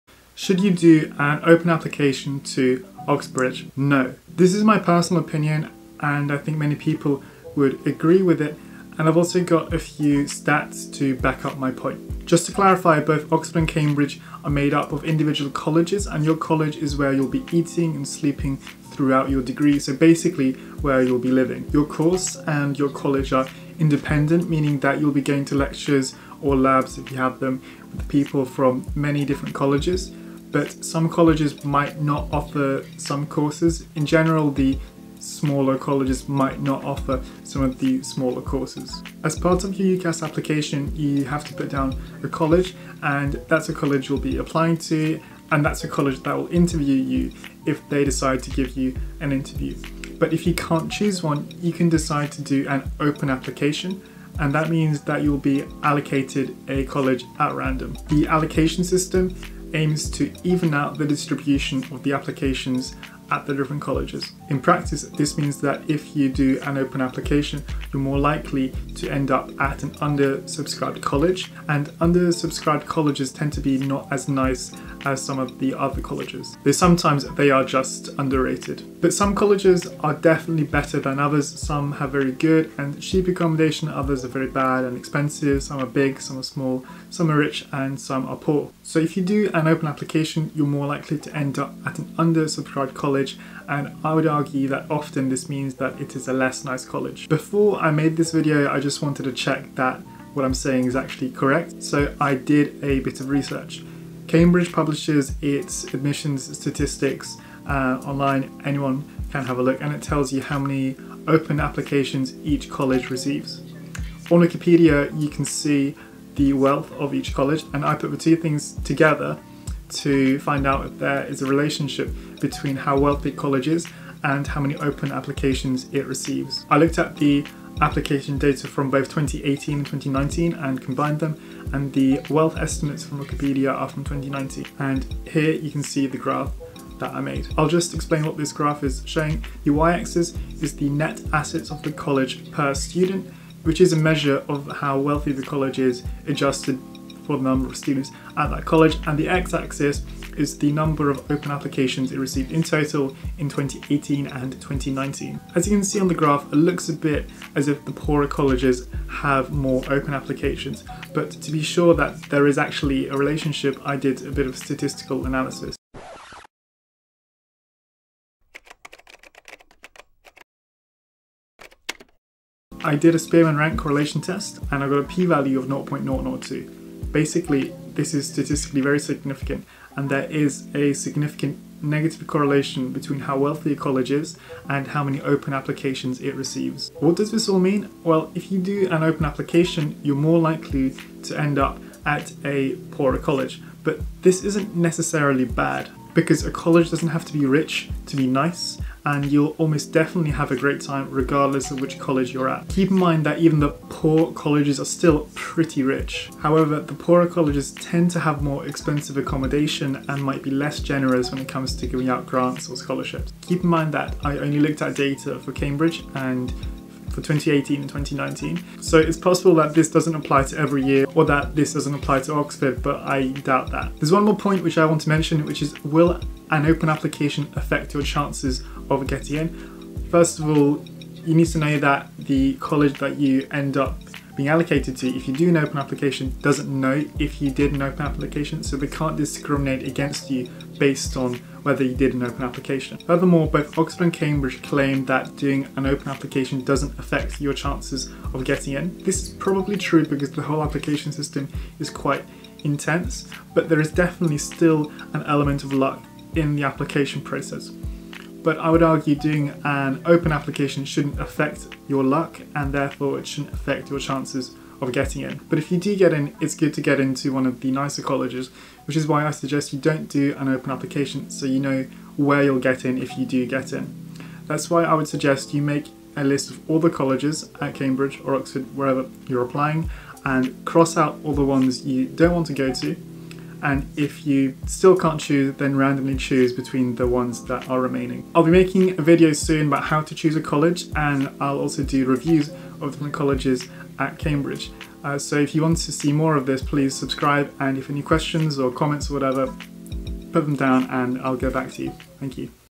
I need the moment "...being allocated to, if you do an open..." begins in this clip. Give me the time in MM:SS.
03:54.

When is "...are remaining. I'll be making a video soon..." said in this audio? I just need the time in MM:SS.
04:47.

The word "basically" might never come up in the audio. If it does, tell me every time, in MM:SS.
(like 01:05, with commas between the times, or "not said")
00:19, 02:57.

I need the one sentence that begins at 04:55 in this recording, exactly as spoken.
Uh, so if you want to see more of this, please subscribe.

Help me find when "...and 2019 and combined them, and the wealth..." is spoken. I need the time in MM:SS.
02:09.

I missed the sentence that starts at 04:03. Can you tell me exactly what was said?
Furthermore, both Oxford and Cambridge claim that doing an open application doesn't affect your chances of getting in.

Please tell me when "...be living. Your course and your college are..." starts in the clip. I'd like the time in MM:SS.
00:21.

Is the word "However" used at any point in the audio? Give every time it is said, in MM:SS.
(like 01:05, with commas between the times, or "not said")
03:26.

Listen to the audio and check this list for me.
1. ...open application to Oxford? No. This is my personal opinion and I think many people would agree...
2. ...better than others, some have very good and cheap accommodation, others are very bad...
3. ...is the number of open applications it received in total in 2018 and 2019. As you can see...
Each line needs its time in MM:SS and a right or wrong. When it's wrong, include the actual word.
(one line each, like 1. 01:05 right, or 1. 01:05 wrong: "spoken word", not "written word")
1. 00:01 wrong: "Oxbridge", not "Oxford"
2. 01:20 right
3. 02:30 right.